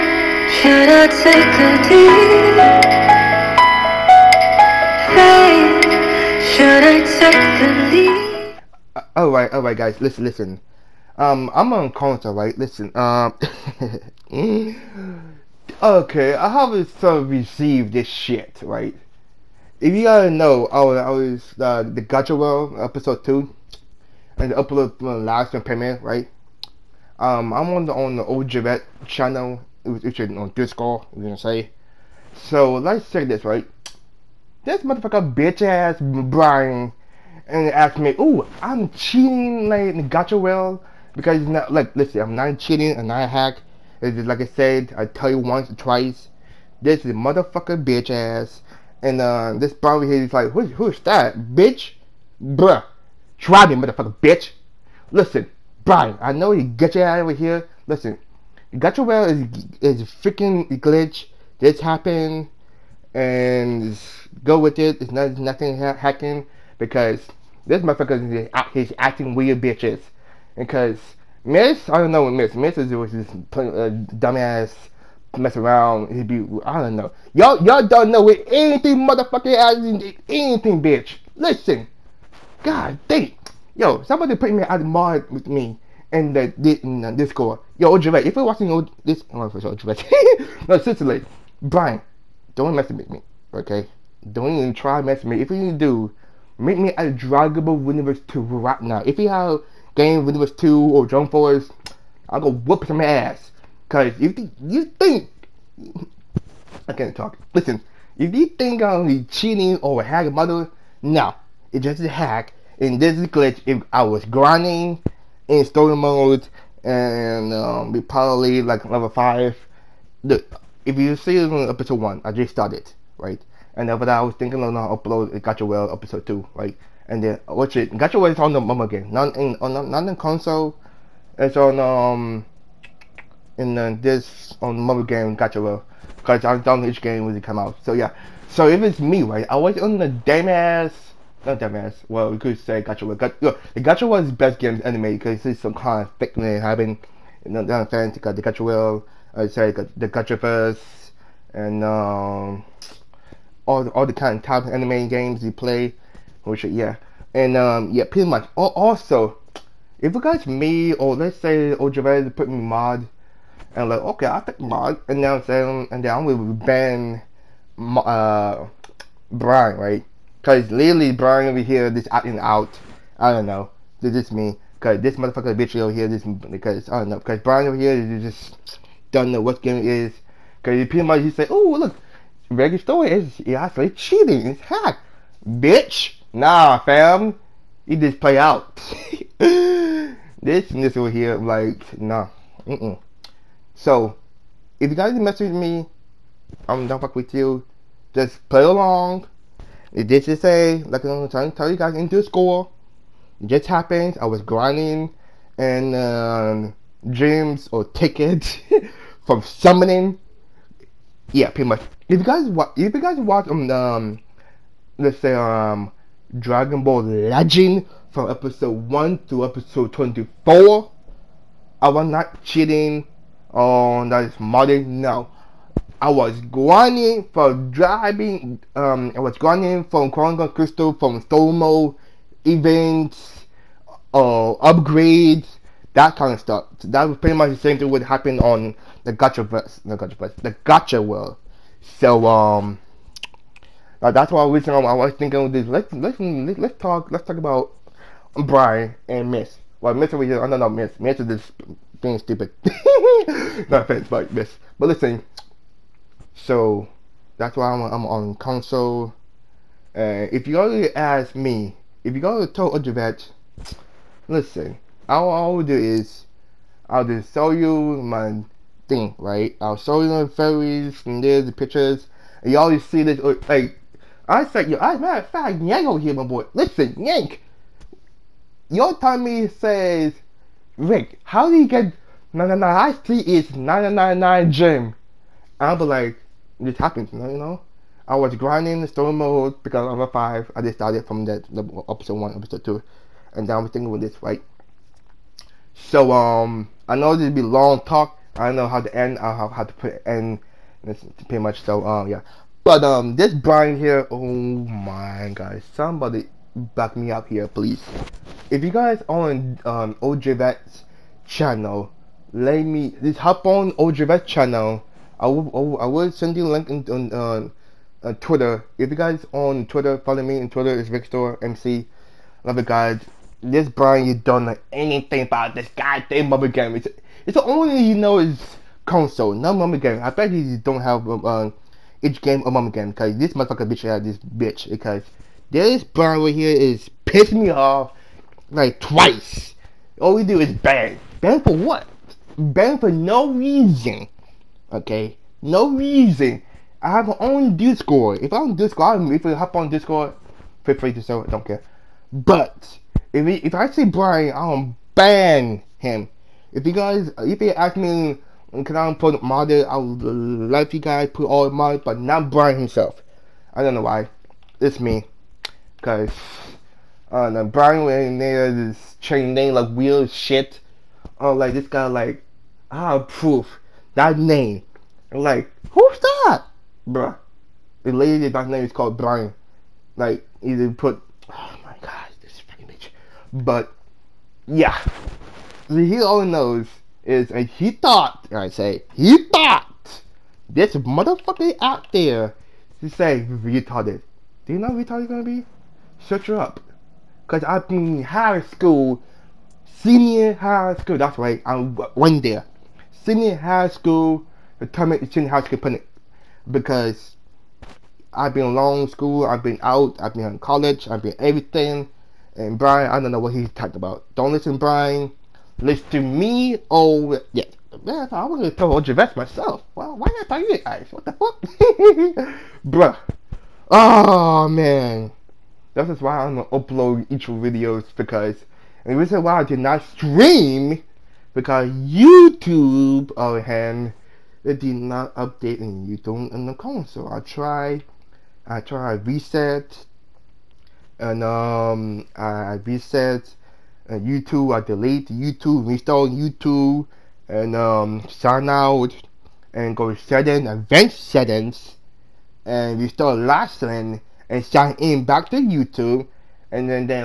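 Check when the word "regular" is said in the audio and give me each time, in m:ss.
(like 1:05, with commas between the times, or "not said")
3:02.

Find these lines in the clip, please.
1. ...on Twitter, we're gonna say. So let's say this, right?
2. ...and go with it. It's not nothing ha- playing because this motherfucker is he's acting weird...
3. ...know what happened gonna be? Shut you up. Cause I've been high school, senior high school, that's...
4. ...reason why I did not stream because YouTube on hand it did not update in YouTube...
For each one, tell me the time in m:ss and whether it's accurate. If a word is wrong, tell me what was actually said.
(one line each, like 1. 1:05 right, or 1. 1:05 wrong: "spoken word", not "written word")
1. 0:30 wrong: "Discord", not "Twitter"
2. 1:03 wrong: "hacking", not "playing"
3. 6:34 wrong: "retarded", not "happened"
4. 7:08 right.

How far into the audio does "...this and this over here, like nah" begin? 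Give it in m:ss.
3:09.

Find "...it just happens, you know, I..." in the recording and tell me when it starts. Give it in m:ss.
4:46.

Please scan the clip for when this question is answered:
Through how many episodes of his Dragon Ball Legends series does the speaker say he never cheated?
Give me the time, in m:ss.
3:39.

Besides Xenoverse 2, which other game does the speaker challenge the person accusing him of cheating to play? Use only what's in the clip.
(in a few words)
Jump Force.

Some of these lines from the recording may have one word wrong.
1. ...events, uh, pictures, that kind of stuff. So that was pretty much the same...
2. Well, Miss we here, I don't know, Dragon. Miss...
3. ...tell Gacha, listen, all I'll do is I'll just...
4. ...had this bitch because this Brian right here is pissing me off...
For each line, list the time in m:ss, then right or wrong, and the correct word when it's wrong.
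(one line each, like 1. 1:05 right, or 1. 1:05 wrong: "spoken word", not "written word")
1. 3:52 wrong: "upgrades", not "pictures"
2. 4:09 wrong: "Miss", not "Dragon"
3. 4:22 wrong: "OGVexx", not "Gacha"
4. 5:33 right.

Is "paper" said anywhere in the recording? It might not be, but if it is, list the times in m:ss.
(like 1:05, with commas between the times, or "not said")
not said.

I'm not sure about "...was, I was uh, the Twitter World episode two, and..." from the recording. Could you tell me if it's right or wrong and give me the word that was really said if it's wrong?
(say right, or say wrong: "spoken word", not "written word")
wrong: "Gacha", not "Twitter".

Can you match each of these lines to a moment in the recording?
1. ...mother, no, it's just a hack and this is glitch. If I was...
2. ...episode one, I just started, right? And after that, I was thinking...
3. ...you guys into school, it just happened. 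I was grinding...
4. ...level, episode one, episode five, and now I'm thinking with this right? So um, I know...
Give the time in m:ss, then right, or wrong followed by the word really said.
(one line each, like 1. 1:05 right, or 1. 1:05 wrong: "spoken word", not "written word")
1. 1:50 right
2. 2:01 right
3. 3:21 right
4. 4:51 wrong: "two", not "five".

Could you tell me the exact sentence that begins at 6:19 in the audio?
Like, either put, oh my god, this fucking bitch.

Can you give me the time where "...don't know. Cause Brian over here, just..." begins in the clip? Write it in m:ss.
2:56.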